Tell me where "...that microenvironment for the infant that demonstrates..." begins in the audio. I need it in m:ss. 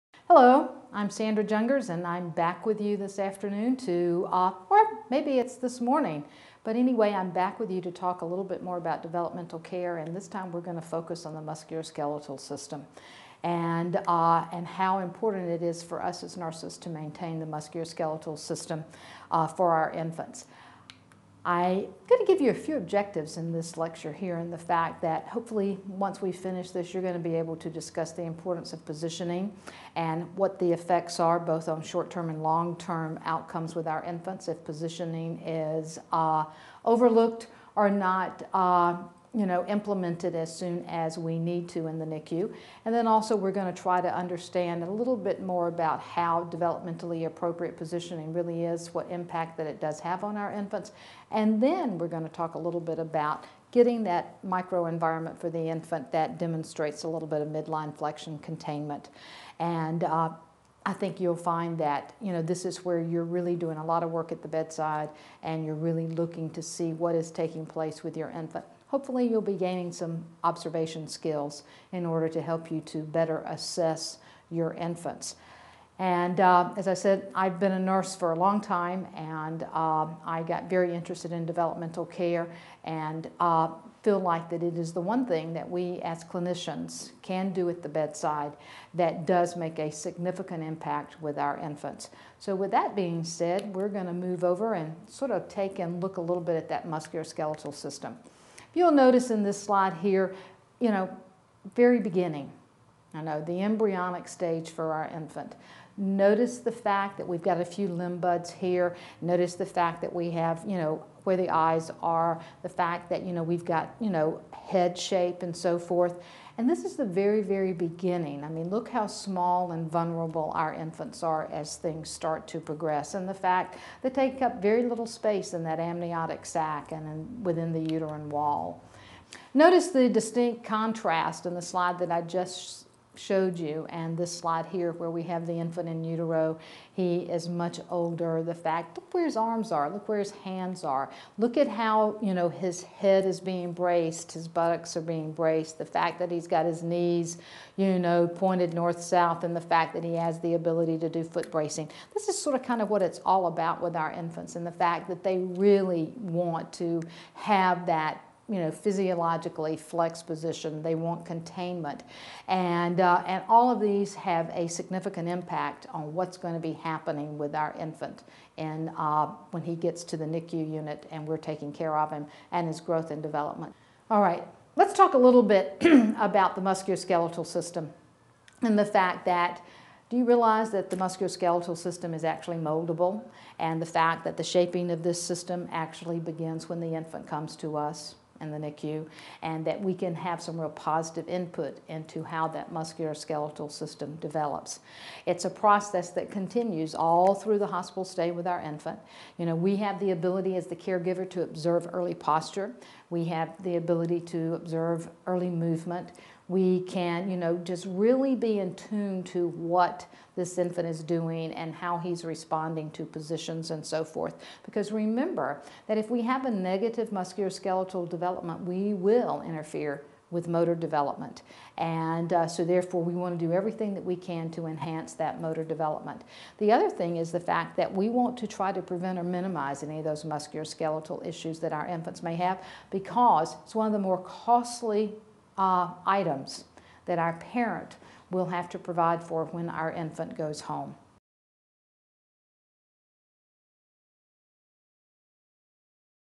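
0:54.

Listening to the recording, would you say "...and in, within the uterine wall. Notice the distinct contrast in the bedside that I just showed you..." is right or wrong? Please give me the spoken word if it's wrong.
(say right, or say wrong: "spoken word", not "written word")
wrong: "slide", not "bedside".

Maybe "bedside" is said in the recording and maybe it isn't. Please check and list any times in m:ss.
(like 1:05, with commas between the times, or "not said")
1:04, 1:27.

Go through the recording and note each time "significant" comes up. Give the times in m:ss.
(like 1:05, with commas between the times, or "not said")
1:29, 2:44.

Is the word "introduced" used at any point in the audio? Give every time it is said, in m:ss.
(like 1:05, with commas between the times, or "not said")
not said.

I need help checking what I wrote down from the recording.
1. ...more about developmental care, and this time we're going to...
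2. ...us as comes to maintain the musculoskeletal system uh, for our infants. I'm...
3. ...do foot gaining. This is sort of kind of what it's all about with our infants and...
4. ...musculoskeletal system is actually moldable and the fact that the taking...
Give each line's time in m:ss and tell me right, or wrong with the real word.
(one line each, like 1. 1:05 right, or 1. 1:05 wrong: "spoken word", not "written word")
1. 0:08 right
2. 0:16 wrong: "nurses", not "comes"
3. 2:31 wrong: "bracing", not "gaining"
4. 3:00 wrong: "shaping", not "taking".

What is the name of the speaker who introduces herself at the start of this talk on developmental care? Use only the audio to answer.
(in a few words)
Sandra Jungers.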